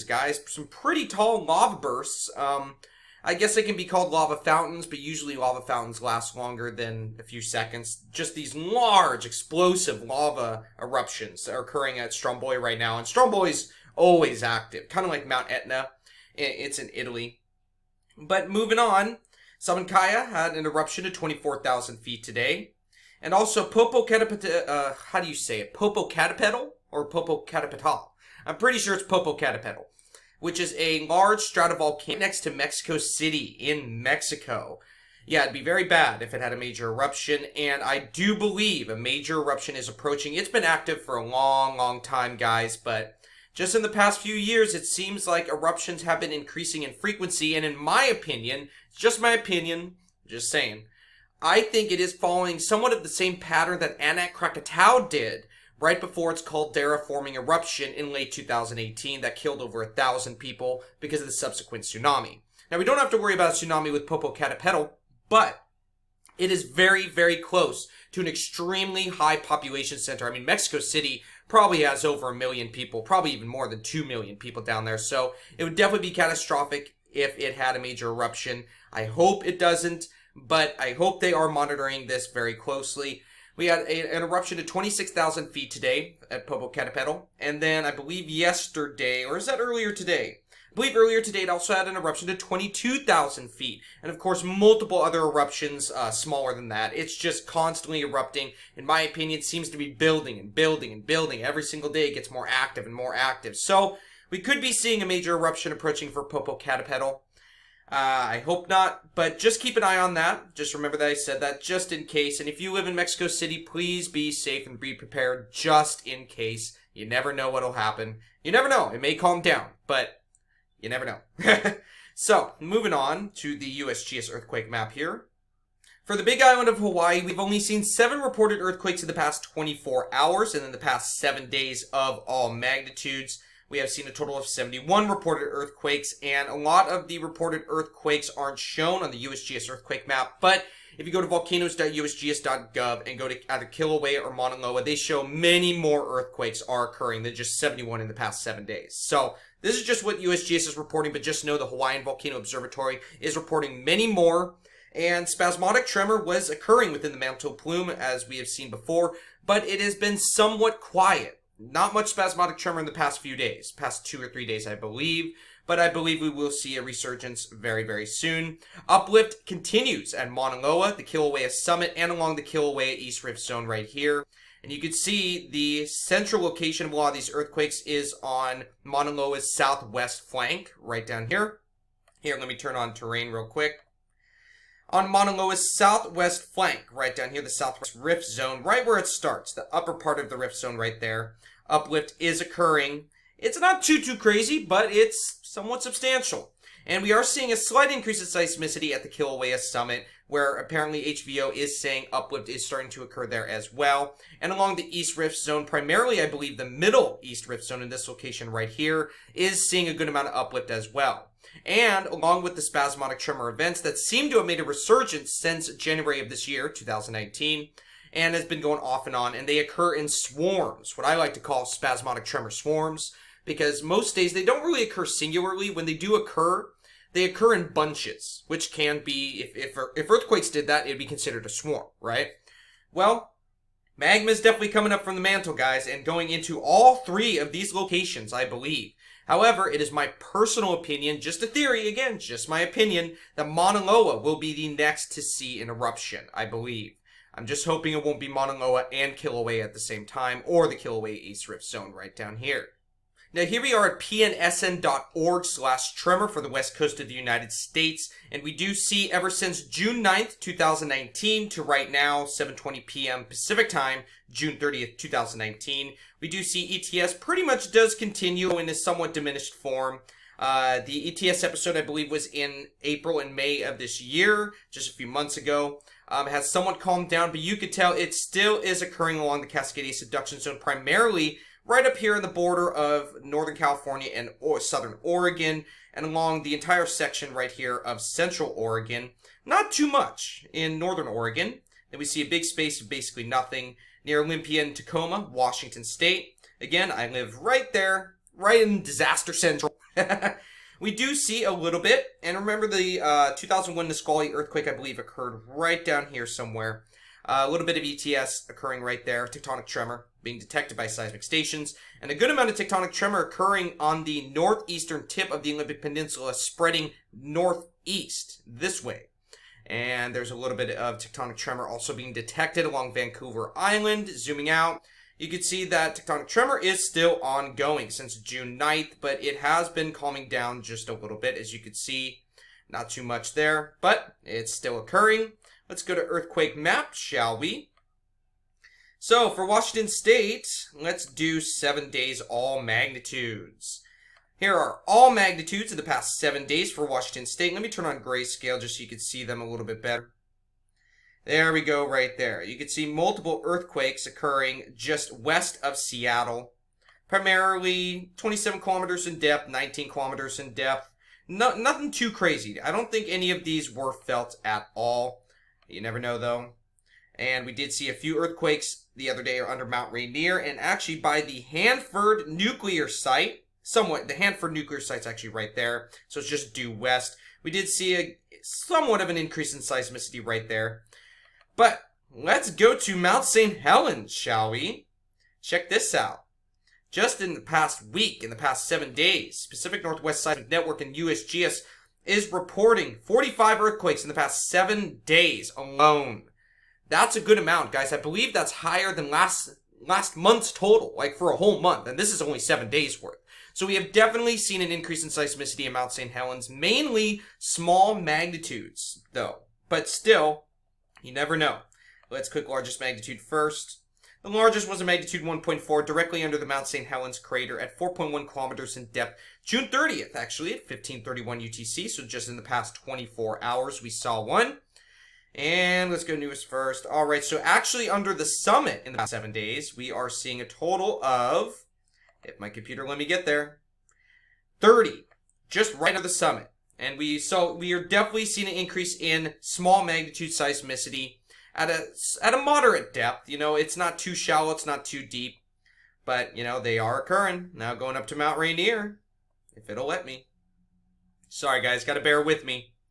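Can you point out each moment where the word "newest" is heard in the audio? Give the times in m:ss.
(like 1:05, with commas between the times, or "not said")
7:06.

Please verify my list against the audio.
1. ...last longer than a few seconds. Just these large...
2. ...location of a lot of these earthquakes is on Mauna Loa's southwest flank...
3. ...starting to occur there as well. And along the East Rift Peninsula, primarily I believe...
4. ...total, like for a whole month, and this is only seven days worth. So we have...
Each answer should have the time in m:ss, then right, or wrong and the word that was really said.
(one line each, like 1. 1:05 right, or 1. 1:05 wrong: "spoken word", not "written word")
1. 0:06 right
2. 2:56 right
3. 3:22 wrong: "Zone", not "Peninsula"
4. 6:40 right.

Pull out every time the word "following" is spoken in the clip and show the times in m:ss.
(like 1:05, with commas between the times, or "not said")
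0:52.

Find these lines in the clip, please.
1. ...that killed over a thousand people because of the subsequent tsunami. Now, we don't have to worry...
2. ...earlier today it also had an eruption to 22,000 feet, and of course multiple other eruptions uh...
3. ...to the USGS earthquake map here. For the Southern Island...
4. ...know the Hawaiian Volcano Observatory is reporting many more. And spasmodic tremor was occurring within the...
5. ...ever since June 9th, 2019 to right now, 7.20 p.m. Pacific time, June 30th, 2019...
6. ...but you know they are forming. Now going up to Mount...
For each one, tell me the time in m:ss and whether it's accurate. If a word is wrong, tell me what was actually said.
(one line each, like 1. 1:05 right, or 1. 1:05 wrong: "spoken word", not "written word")
1. 0:59 right
2. 1:30 right
3. 2:03 wrong: "Big", not "Southern"
4. 2:31 right
5. 4:19 right
6. 7:26 wrong: "occurring", not "forming".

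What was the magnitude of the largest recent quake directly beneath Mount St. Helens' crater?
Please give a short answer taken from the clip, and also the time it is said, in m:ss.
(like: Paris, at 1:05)
1.4, at 6:55.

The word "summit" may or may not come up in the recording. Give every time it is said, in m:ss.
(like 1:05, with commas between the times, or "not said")
2:51, 3:19, 7:08, 7:16.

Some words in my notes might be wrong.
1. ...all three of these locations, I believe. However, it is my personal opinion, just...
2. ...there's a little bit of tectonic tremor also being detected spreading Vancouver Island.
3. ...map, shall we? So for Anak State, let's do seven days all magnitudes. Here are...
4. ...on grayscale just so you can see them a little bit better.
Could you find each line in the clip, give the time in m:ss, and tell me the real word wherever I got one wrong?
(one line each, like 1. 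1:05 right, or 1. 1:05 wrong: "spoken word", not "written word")
1. 3:56 right
2. 5:20 wrong: "along", not "spreading"
3. 5:36 wrong: "Washington", not "Anak"
4. 5:47 right.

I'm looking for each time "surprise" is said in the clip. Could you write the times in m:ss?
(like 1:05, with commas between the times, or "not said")
not said.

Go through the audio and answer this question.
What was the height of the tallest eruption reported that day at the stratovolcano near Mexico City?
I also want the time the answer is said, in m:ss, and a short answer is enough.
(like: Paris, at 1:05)
26,000 feet, at 1:24.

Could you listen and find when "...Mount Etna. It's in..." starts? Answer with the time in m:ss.
0:15.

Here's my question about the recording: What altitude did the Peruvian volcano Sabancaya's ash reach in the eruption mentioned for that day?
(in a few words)
24,000 feet.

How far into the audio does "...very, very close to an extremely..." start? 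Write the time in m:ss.
1:06.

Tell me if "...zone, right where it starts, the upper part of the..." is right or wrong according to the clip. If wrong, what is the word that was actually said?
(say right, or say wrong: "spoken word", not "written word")
right.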